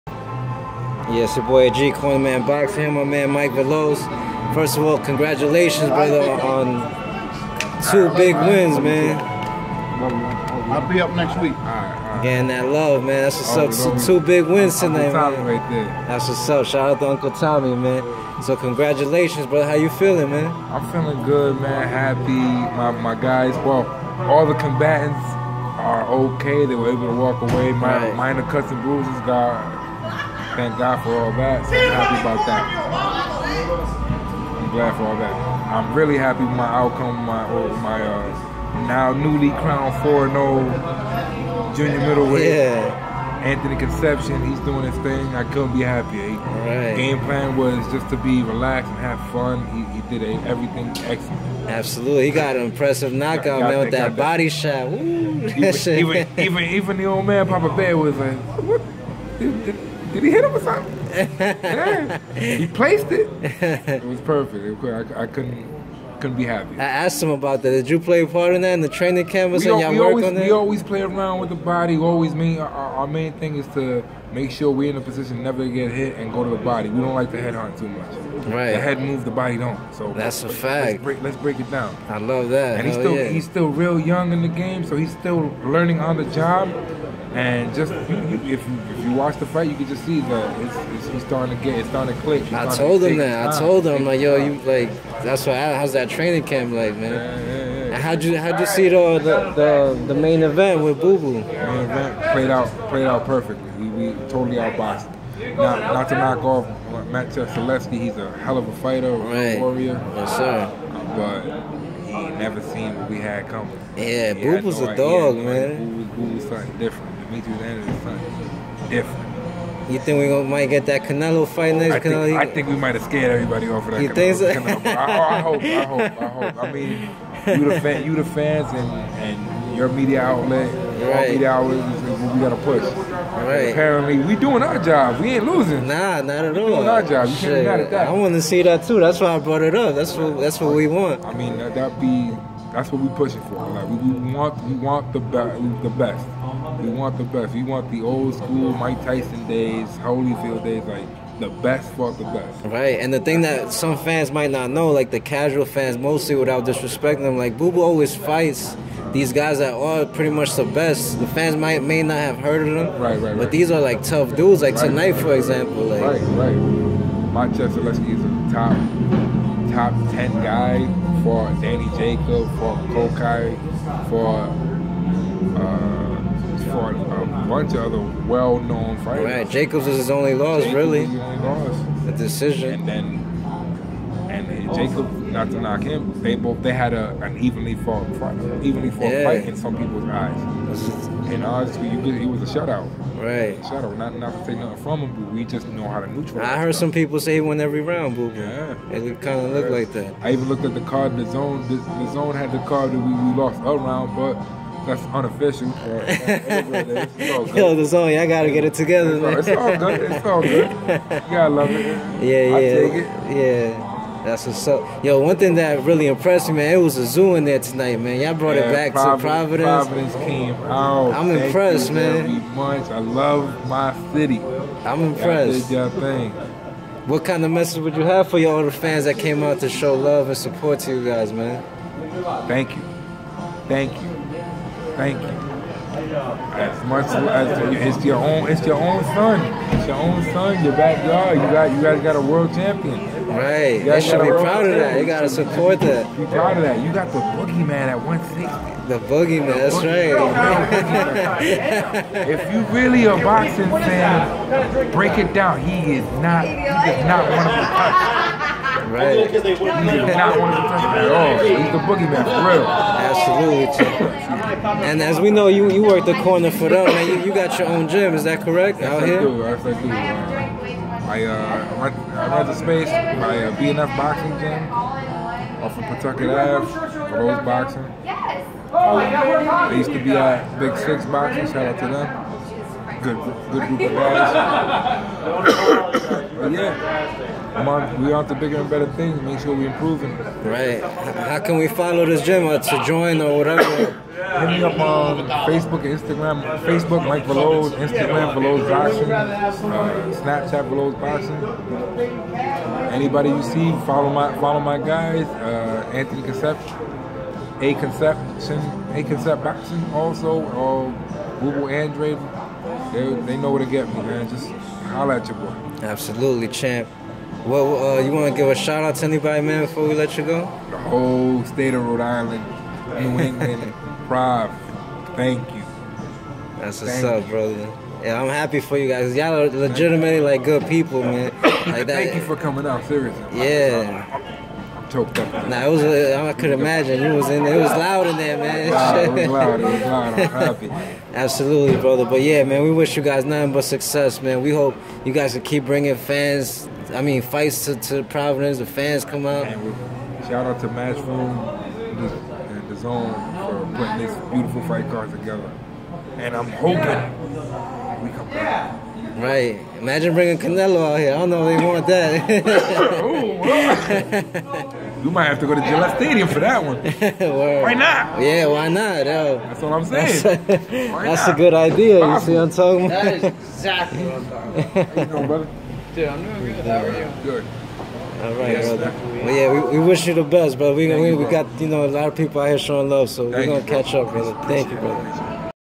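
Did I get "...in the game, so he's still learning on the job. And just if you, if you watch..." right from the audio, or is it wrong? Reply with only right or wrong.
right.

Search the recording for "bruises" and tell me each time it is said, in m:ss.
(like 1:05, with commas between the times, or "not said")
0:28.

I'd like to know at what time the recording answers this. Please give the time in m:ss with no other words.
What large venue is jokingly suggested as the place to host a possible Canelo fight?
6:05.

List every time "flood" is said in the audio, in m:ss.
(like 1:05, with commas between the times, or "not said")
not said.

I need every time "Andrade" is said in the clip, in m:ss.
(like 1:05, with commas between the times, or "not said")
1:57, 5:11.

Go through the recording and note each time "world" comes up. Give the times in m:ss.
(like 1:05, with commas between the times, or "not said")
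4:02.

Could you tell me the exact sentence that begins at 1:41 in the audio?
Main event played out played out perfectly.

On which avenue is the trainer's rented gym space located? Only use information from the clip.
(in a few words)
Pawtucket Ave.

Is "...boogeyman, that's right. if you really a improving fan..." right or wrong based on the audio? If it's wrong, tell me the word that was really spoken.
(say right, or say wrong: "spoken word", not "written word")
wrong: "boxing", not "improving".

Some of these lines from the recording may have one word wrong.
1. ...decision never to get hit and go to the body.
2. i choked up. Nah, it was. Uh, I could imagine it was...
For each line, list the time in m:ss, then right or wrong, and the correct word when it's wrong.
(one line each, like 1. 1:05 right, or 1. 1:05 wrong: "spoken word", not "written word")
1. 1:15 wrong: "position", not "decision"
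2. 5:34 right.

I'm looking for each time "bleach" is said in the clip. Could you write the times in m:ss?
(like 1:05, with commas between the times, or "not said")
not said.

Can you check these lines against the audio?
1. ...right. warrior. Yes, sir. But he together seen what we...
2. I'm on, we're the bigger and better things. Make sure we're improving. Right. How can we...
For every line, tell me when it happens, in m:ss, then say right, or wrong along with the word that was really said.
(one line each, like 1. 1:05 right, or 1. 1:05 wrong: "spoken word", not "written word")
1. 1:49 wrong: "never", not "together"
2. 4:47 right.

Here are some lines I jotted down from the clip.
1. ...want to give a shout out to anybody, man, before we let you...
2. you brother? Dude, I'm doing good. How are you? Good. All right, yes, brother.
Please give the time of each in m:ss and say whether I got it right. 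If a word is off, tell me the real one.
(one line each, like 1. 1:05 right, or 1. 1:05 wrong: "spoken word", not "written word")
1. 5:18 right
2. 6:14 right.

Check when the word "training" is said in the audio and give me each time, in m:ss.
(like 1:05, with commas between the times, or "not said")
1:08, 1:36.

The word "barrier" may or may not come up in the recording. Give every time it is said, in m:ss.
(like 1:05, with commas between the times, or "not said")
not said.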